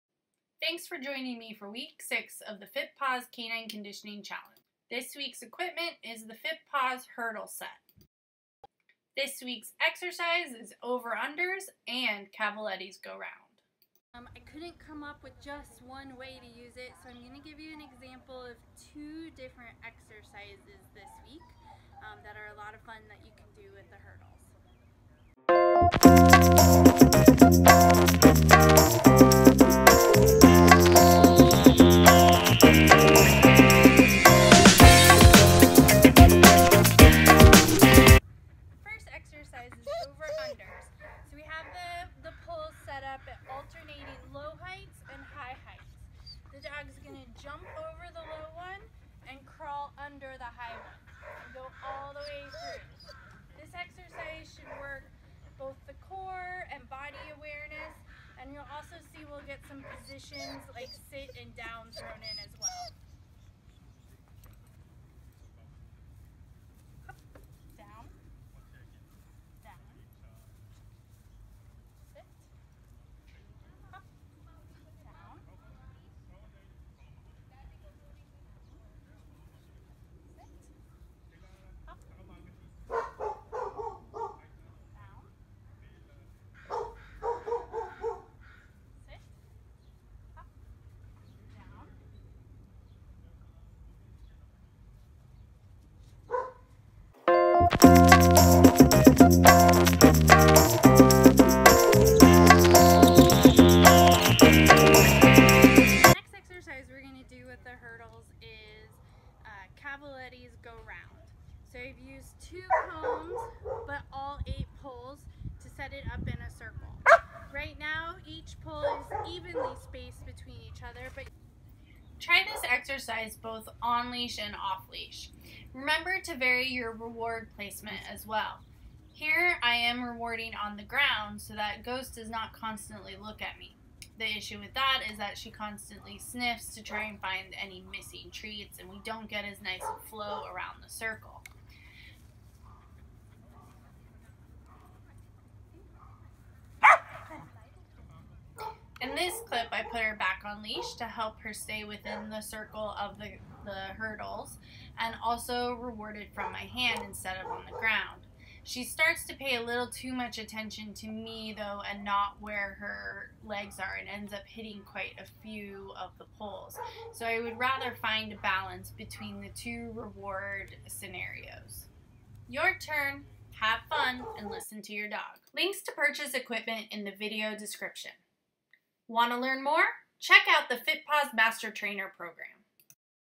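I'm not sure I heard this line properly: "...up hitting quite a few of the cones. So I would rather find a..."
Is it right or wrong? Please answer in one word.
wrong.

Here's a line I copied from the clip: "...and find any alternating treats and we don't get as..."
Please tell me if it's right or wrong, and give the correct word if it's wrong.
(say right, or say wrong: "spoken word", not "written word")
wrong: "missing", not "alternating".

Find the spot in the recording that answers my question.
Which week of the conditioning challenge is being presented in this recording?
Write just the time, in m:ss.
0:02.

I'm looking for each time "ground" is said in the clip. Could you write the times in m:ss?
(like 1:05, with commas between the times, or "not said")
2:10, 2:37.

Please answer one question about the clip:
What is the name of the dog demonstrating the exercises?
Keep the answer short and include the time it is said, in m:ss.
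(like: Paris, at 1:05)
Ghost, at 2:11.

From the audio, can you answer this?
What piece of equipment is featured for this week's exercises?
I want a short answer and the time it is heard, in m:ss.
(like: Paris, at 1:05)
Fit Hurdle Set, at 0:06.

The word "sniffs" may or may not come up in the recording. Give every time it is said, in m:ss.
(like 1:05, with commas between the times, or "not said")
2:16.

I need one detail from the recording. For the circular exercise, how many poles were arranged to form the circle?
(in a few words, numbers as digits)
8.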